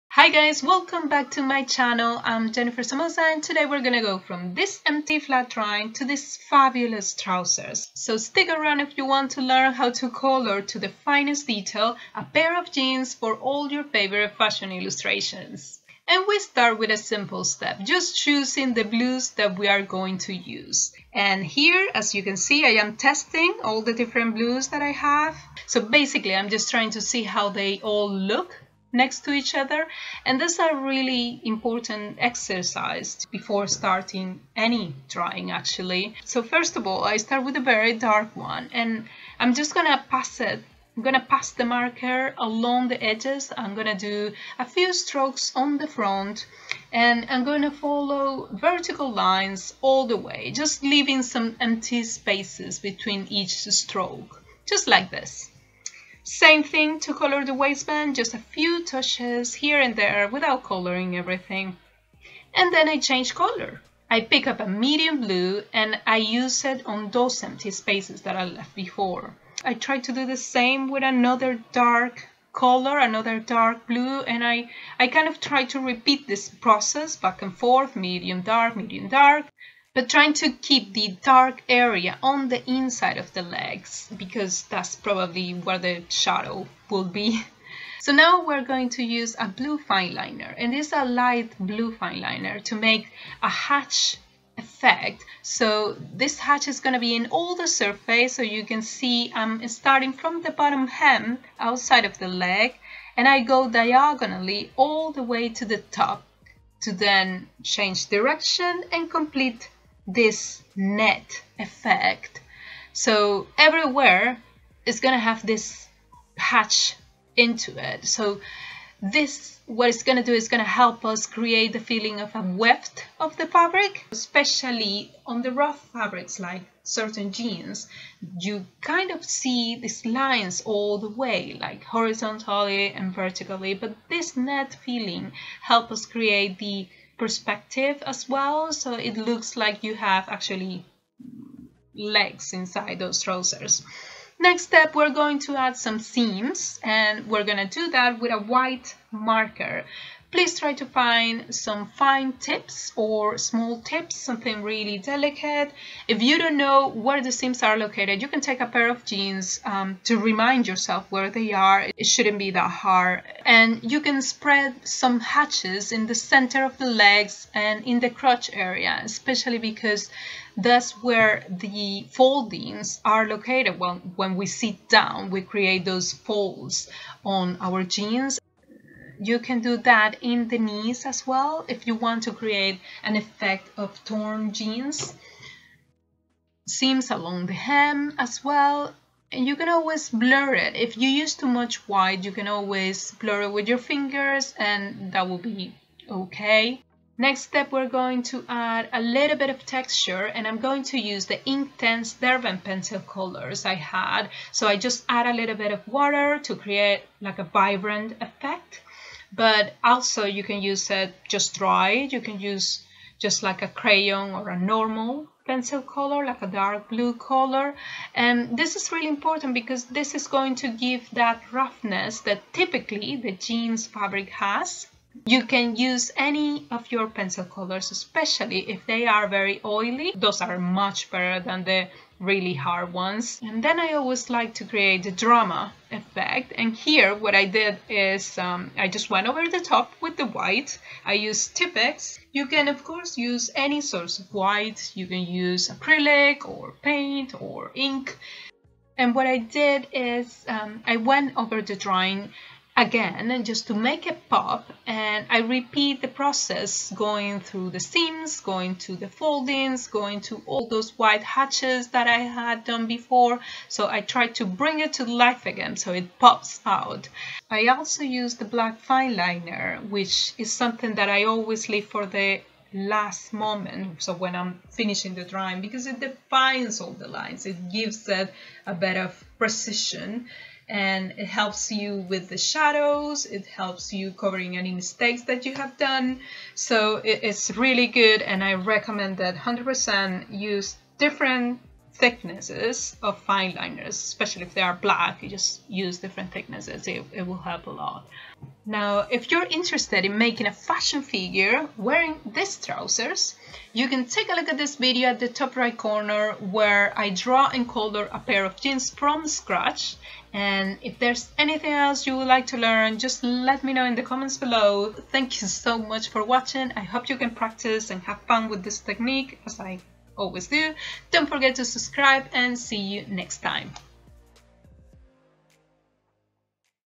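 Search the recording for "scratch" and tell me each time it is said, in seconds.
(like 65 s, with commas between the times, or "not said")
309 s.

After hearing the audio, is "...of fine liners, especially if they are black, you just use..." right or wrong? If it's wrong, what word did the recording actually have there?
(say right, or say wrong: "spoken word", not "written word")
right.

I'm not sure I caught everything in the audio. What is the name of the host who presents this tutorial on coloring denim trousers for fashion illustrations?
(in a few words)
Jennifer Somoza.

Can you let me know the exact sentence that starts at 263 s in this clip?
So I try to bring it to life again so it pops out.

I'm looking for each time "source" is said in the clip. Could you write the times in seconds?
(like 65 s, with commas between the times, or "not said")
243 s.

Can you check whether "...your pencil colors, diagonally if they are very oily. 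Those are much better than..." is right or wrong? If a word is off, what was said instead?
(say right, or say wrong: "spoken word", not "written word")
wrong: "especially", not "diagonally".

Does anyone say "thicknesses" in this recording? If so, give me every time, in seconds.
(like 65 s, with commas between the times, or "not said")
291 s, 296 s.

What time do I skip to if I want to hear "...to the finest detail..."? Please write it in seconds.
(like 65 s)
10 s.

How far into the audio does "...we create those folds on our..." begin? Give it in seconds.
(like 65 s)
175 s.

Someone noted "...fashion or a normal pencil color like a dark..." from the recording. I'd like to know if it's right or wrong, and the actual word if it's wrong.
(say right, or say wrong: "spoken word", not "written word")
wrong: "crayon", not "fashion".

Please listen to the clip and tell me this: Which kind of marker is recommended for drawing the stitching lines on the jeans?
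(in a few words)
White marker.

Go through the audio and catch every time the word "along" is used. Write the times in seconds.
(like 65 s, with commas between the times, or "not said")
42 s, 187 s.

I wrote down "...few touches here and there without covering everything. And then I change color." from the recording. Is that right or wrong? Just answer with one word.
wrong.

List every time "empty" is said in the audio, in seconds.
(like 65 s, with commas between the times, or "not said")
4 s, 51 s, 67 s.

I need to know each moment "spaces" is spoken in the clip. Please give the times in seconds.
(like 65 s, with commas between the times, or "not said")
52 s, 67 s.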